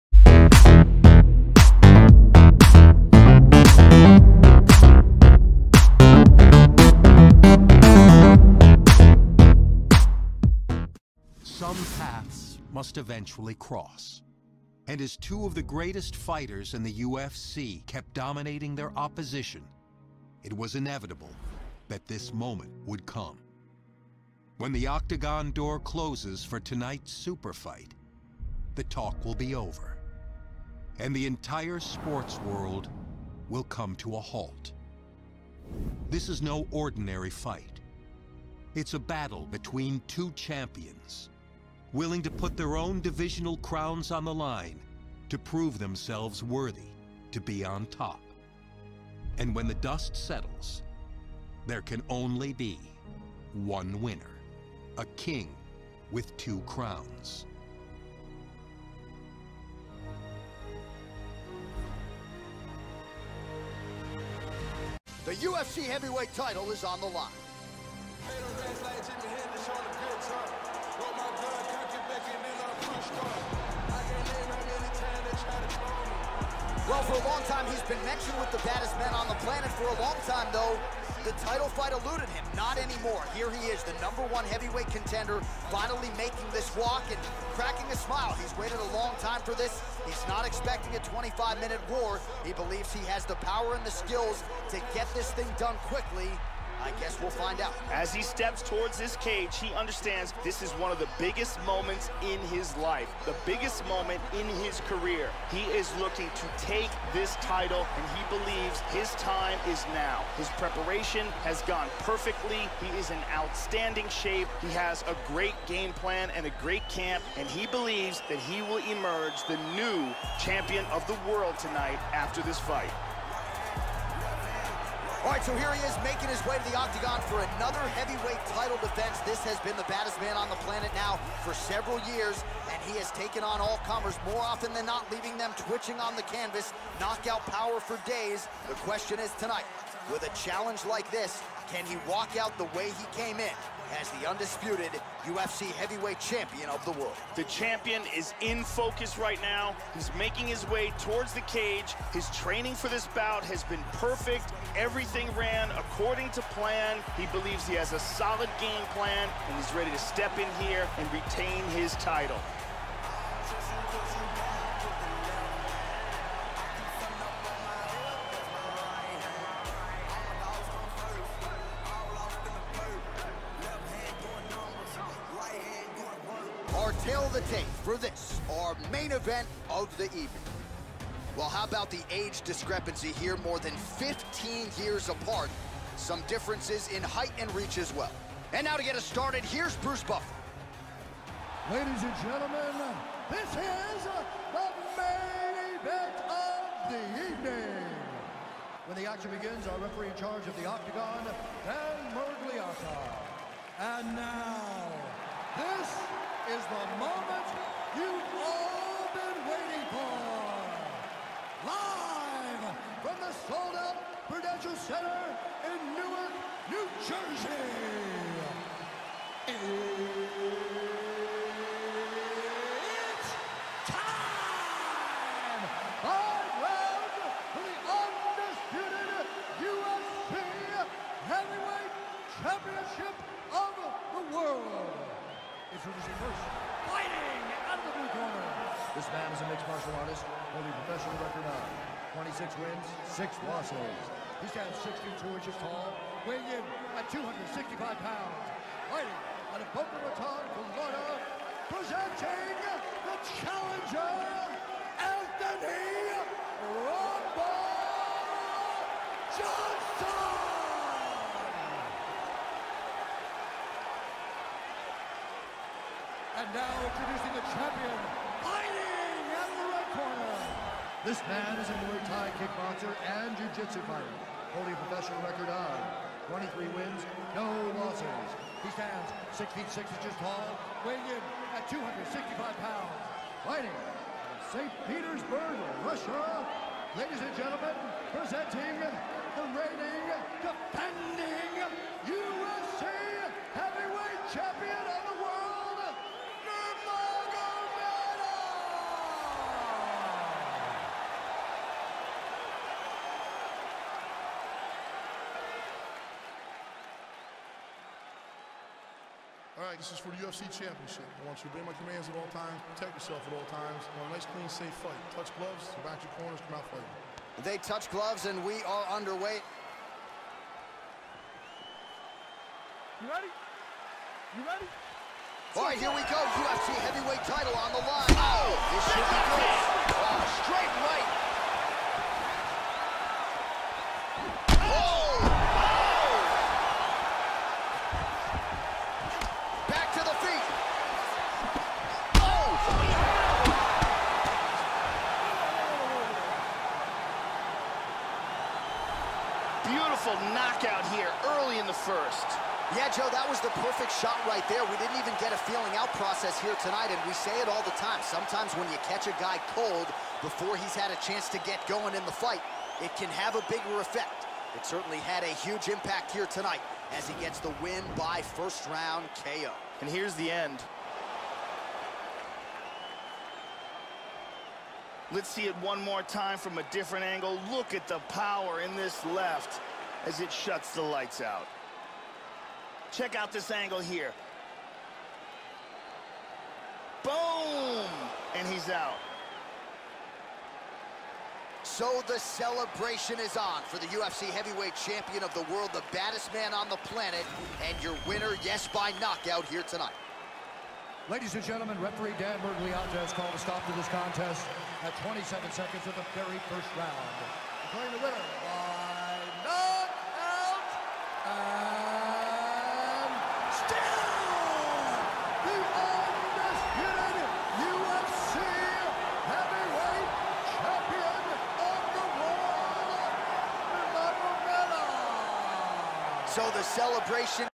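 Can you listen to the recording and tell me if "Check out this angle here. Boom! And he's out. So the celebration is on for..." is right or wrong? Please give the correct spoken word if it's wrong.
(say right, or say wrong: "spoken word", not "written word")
right.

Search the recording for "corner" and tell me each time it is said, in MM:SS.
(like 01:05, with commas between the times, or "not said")
03:58, 05:16.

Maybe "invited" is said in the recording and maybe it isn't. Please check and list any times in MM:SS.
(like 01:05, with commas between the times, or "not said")
not said.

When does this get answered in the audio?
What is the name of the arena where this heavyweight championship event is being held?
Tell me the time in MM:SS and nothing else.
03:34.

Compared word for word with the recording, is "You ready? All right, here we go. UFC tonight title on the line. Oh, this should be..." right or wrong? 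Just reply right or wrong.
wrong.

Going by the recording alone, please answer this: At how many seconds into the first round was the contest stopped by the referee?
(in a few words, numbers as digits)
27.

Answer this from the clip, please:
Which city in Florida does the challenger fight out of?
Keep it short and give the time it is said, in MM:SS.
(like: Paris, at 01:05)
Boca Raton, at 04:09.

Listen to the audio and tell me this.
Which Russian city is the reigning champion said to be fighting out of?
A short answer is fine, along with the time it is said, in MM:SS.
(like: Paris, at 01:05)
St. Petersburg, at 04:44.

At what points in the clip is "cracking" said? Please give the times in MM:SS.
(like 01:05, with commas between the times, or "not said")
01:27.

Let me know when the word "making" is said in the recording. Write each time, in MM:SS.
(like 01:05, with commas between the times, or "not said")
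01:26, 02:06, 02:30.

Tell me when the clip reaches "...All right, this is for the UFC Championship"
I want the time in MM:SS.
05:09.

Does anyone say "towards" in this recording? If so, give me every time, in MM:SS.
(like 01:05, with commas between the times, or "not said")
01:38, 02:30.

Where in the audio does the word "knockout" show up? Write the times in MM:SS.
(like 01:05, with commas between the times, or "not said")
02:16, 05:50, 06:39, 06:49.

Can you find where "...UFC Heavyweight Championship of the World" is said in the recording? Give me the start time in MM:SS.
03:49.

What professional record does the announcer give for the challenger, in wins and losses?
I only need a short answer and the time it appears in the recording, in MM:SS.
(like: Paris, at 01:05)
26 wins, 6 losses, at 04:02.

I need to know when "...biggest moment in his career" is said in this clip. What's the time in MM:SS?
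01:43.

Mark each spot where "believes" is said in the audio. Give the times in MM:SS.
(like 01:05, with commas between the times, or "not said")
01:32, 01:48, 01:57, 02:37.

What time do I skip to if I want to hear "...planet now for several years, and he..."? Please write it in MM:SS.
02:10.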